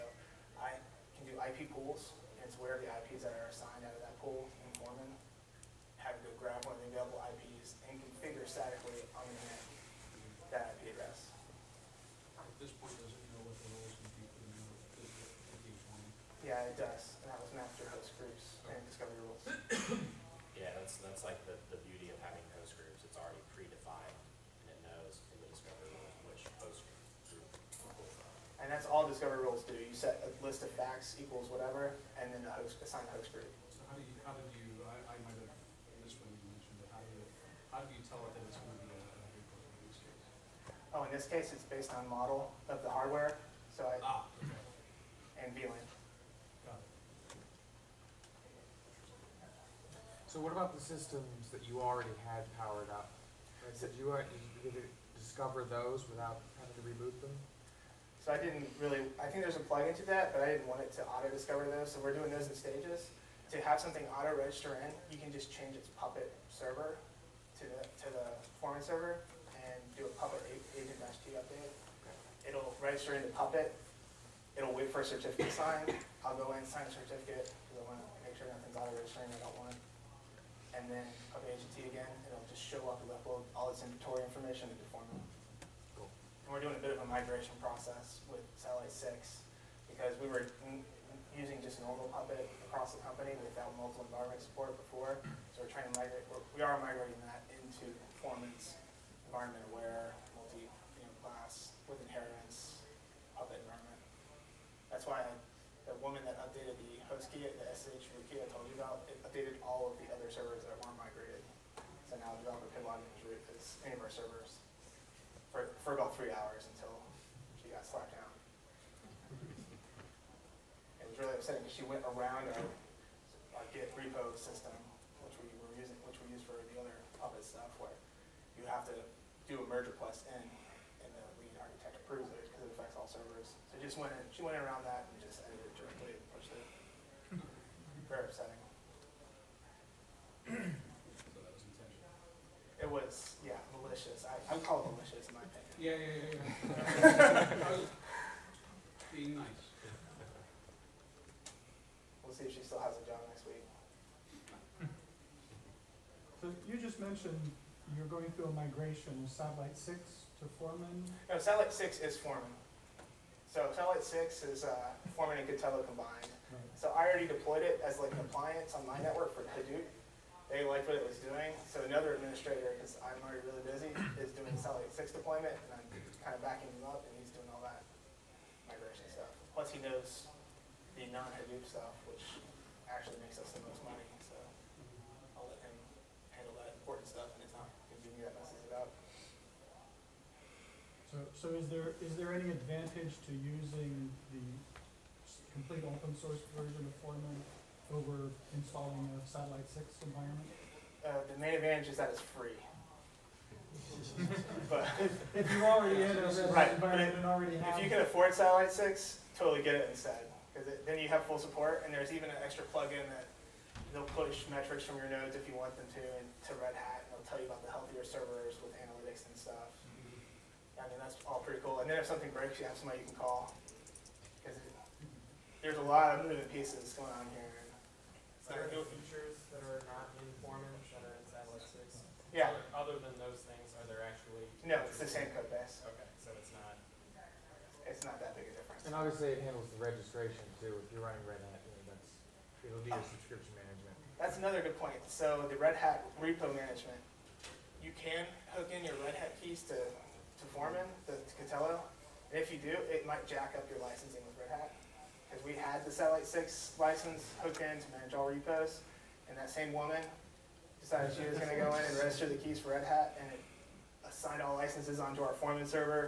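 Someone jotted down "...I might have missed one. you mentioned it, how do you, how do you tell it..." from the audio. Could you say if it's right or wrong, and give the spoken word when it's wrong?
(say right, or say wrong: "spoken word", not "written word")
right.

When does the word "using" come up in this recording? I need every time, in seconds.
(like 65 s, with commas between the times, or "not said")
91 s, 125 s, 193 s.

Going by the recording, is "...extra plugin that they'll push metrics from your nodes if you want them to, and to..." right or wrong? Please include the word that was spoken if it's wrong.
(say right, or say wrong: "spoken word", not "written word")
right.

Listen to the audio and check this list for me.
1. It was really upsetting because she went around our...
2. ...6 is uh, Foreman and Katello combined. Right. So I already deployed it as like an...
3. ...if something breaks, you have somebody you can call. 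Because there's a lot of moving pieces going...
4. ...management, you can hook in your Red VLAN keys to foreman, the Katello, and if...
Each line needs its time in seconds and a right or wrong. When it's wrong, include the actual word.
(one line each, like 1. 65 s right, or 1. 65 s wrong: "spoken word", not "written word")
1. 121 s right
2. 164 s right
3. 222 s right
4. 246 s wrong: "Hat", not "VLAN".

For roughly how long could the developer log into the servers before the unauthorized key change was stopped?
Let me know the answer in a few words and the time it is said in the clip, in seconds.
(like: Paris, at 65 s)
About 3 hours, at 115 s.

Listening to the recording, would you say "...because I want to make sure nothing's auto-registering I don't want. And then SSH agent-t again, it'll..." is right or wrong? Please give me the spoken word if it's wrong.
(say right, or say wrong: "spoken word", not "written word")
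wrong: "Puppet", not "SSH".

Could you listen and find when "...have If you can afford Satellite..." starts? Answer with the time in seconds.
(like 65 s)
207 s.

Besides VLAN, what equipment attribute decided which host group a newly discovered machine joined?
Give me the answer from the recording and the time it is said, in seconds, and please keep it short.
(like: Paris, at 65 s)
Model of the hardware, at 42 s.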